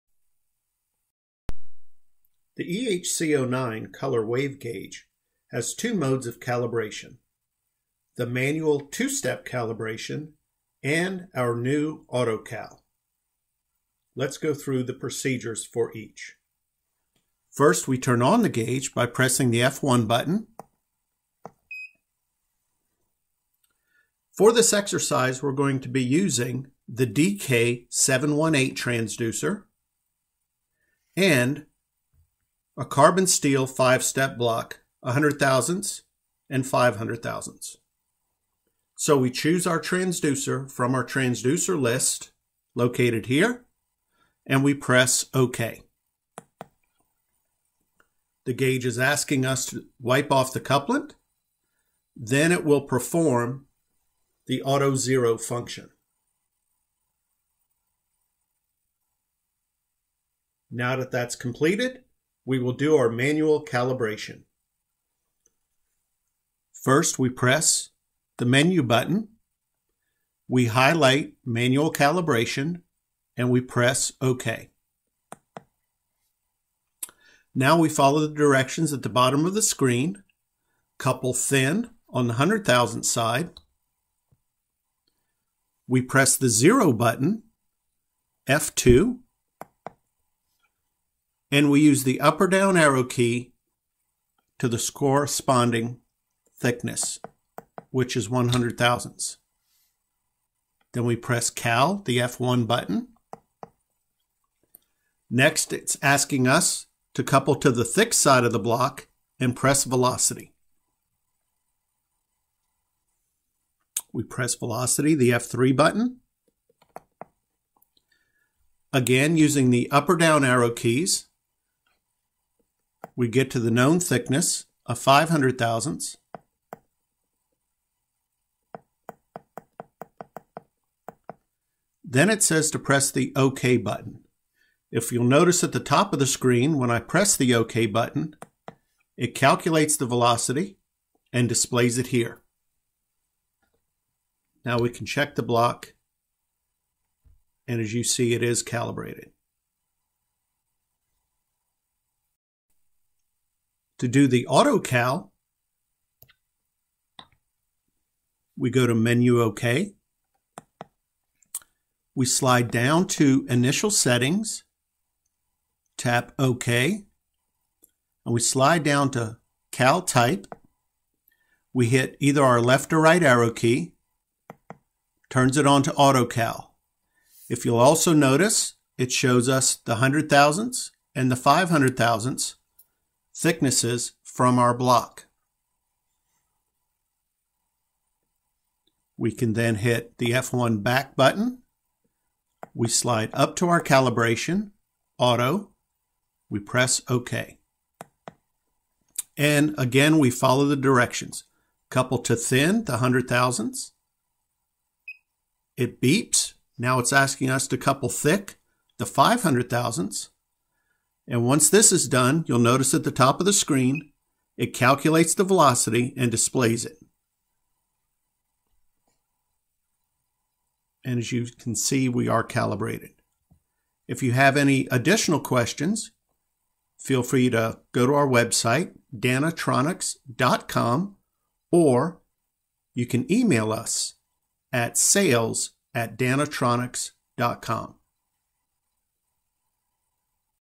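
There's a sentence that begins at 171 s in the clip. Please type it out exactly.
We hit either our left or right arrow key, turns it on to AutoCal.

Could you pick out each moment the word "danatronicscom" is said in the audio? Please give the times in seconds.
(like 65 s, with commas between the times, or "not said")
229 s, 236 s.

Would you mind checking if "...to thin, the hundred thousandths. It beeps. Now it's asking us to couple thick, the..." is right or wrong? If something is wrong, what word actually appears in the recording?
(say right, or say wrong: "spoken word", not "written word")
right.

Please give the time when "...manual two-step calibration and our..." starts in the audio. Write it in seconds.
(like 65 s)
8 s.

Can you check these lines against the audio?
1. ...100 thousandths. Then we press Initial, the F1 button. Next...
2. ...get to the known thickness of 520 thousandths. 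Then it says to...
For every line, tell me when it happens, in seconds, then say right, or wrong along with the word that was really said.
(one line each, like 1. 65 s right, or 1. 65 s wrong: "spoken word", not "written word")
1. 98 s wrong: "Cal", not "Initial"
2. 123 s wrong: "500", not "520".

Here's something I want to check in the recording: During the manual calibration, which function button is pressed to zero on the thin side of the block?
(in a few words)
F2.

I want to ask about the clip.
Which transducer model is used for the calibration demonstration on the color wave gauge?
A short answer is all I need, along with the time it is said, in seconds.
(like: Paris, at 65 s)
DK718, at 27 s.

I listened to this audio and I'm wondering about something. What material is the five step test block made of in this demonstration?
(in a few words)
Carbon steel.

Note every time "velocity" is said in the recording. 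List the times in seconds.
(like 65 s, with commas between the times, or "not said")
109 s, 114 s, 140 s, 215 s.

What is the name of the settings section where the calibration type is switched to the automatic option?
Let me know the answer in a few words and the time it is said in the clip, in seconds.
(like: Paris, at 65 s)
Initial Settings, at 163 s.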